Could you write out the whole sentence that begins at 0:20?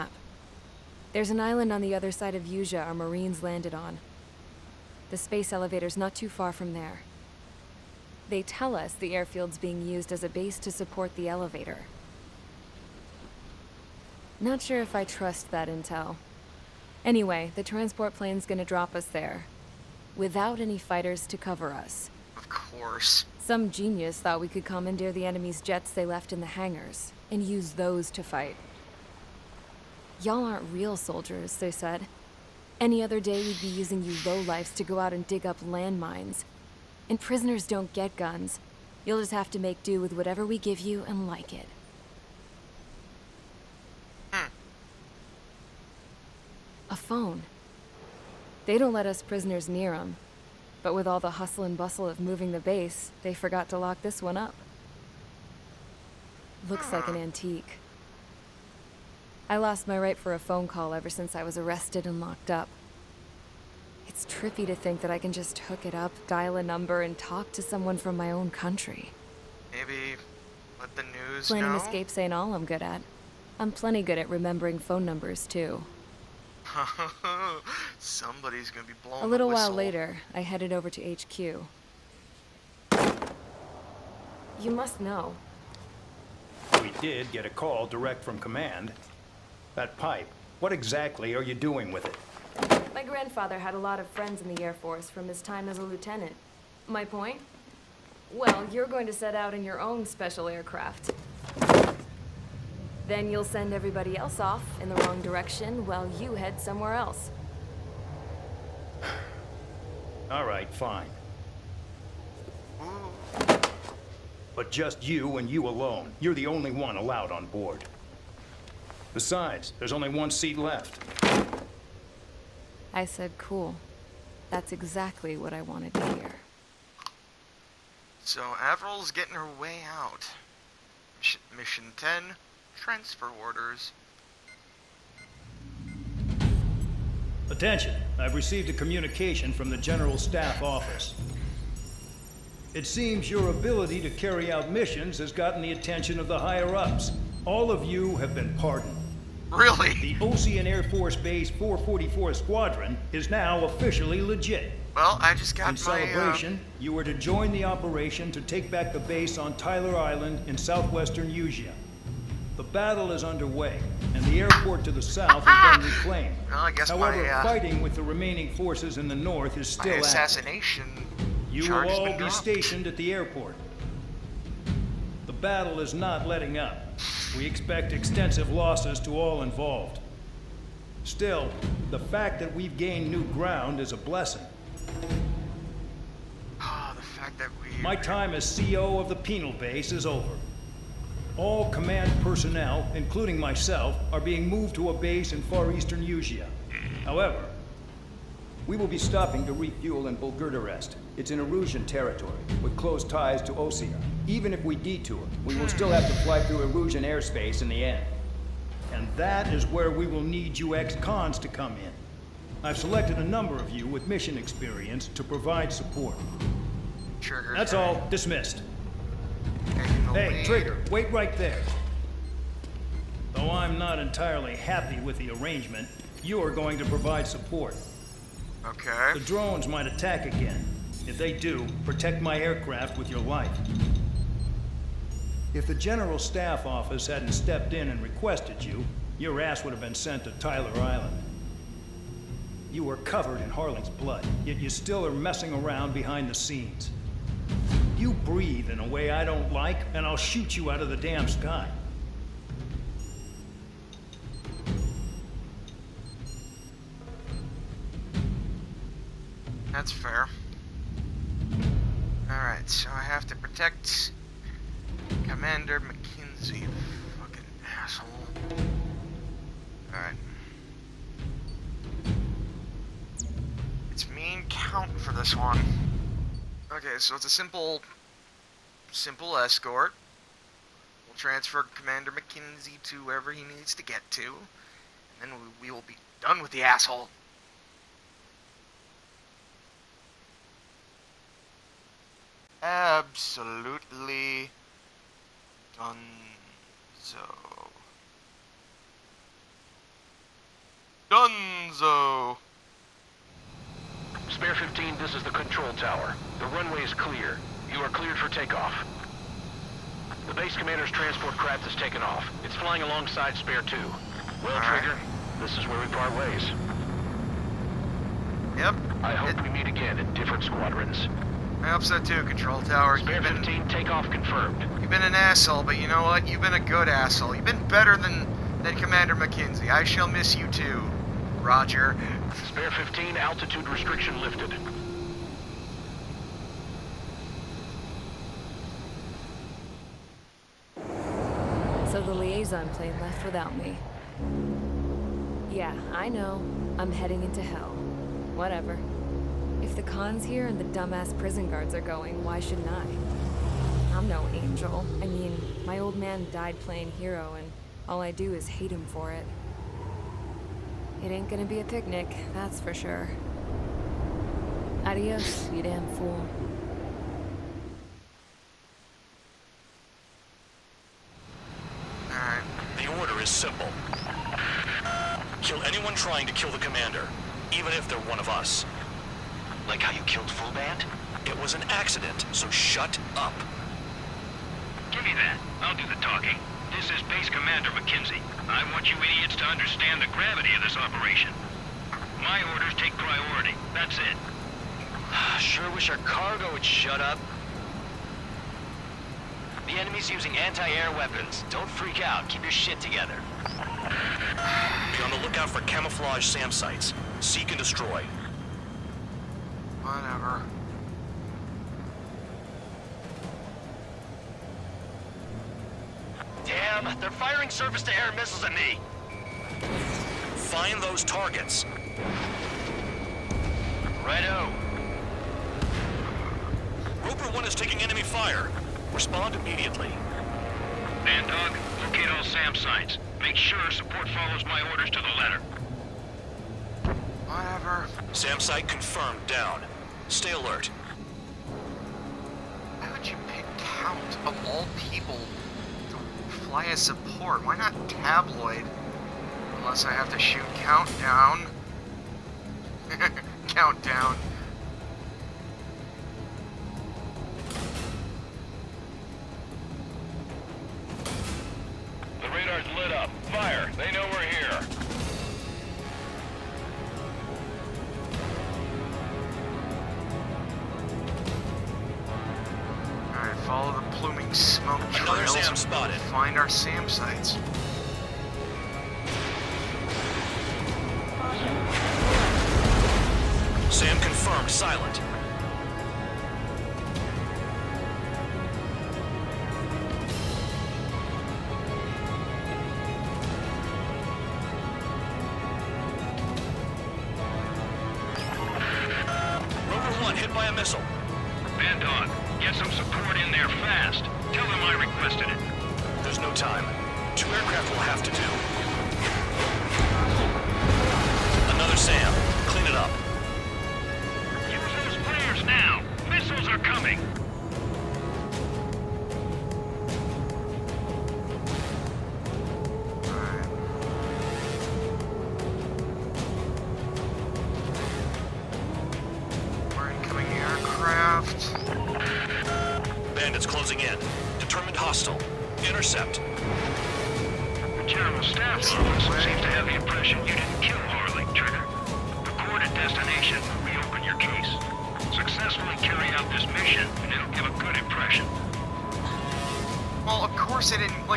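Without any fighters to cover us.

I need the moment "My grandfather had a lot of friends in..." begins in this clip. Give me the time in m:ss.
1:32.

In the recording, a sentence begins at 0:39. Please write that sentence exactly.
You'll just have to make do with whatever we give you and like it.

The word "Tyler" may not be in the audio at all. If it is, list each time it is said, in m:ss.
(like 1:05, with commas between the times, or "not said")
2:39, 4:00.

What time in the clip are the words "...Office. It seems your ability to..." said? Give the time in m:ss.
2:20.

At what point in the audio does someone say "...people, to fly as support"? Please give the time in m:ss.
7:24.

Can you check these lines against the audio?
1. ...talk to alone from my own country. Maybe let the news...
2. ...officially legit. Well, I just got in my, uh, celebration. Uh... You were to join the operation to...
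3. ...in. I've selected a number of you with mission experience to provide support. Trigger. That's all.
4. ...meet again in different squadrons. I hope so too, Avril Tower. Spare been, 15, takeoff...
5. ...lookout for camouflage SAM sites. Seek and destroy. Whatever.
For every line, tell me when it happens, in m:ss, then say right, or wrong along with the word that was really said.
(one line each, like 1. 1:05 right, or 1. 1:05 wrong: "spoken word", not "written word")
1. 1:07 wrong: "someone", not "alone"
2. 2:33 right
3. 3:31 right
4. 5:19 wrong: "Control", not "Avril"
5. 6:45 right.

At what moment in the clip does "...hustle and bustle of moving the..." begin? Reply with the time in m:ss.
0:51.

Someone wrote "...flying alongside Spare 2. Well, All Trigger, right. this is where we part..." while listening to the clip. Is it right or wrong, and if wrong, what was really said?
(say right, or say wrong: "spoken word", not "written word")
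right.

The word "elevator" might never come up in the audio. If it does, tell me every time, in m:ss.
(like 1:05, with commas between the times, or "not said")
0:05, 0:11.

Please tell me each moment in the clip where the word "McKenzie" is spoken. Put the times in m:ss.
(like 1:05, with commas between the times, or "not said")
4:25, 4:42, 5:29, 6:27.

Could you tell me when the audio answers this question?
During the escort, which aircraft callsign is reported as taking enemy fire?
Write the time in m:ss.
7:07.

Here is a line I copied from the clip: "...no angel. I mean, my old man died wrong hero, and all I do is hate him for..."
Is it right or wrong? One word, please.
wrong.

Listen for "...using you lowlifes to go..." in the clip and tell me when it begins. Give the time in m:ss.
0:33.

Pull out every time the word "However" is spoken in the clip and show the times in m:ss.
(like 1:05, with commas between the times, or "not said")
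2:46, 3:17.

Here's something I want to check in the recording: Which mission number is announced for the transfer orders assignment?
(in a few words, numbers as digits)
10.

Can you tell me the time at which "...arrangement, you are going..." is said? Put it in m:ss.
3:45.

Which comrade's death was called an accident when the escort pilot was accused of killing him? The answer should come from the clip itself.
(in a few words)
Full Band.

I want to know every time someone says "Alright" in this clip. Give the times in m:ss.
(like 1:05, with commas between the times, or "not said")
4:22, 4:29, 6:12.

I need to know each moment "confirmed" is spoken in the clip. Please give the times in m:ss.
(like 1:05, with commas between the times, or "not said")
5:24, 7:18.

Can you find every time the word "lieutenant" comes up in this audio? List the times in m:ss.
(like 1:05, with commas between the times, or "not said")
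1:35.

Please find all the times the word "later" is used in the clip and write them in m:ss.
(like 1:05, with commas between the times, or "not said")
1:19.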